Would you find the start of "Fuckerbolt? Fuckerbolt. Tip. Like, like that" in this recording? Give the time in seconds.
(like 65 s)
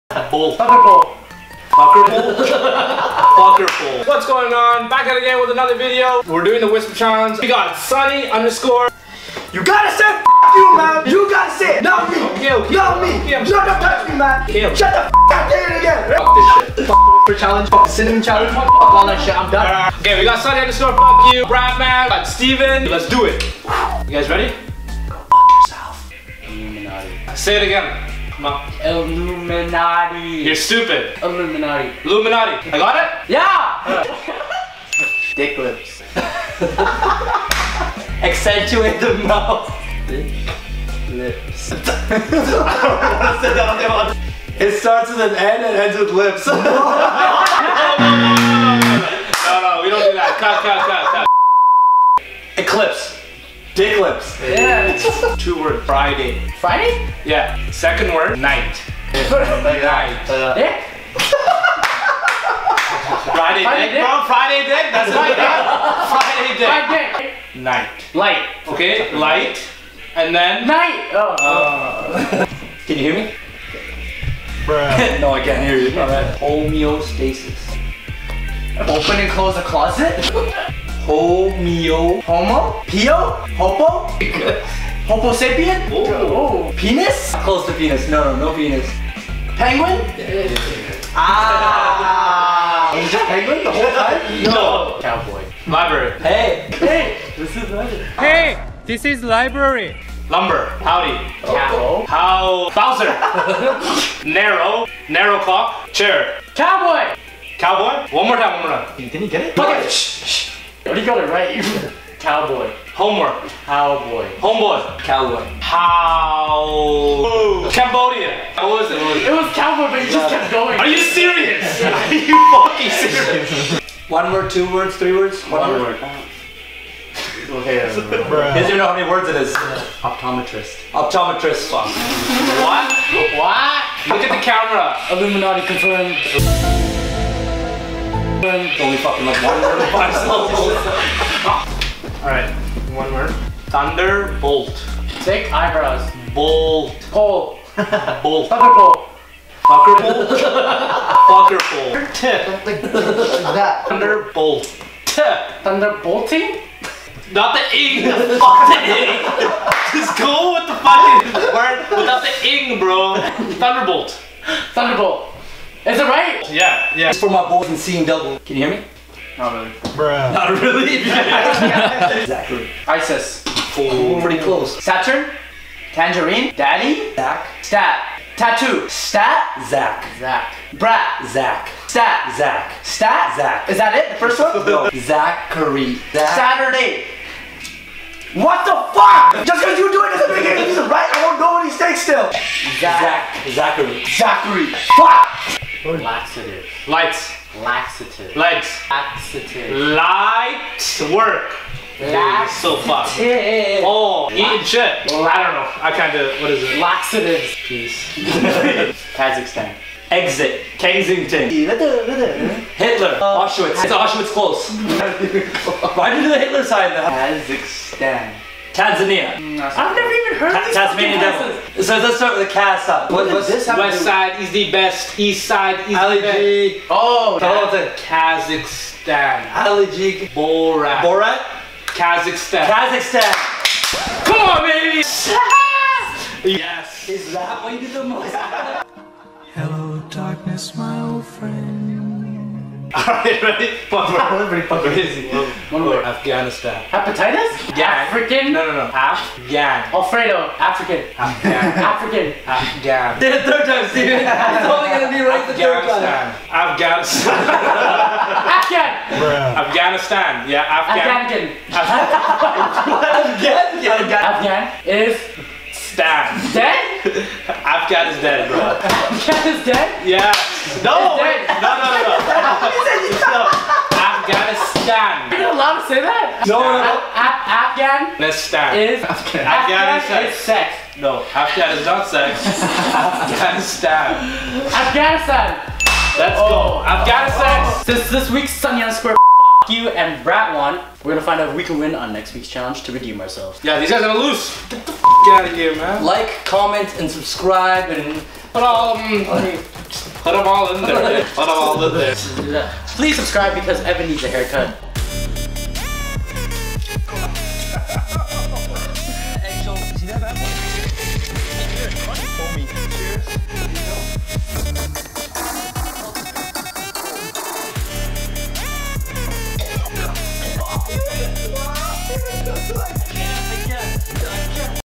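149 s.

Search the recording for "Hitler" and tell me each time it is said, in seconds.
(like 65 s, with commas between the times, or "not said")
211 s, 216 s.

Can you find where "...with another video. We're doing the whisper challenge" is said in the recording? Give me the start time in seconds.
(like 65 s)
5 s.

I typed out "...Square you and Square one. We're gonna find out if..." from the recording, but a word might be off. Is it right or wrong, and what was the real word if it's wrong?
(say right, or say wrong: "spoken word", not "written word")
wrong: "Brat", not "Square".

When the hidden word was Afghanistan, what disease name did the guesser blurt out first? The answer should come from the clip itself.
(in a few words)
Hepatitis.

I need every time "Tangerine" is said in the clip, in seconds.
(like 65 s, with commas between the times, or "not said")
175 s.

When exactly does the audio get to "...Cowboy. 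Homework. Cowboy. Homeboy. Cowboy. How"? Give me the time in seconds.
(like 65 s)
112 s.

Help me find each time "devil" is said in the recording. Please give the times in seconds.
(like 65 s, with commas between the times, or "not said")
221 s.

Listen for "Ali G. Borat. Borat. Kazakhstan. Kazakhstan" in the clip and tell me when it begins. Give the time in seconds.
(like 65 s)
229 s.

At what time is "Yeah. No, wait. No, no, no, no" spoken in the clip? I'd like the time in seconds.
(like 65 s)
270 s.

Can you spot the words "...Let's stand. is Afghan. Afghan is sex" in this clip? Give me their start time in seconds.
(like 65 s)
278 s.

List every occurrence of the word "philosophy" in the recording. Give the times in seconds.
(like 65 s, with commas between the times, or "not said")
not said.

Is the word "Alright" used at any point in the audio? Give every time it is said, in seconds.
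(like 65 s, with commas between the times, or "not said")
142 s, 242 s.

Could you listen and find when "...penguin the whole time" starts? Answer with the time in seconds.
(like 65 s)
93 s.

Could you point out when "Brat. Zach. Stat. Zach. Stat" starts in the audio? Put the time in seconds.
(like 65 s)
180 s.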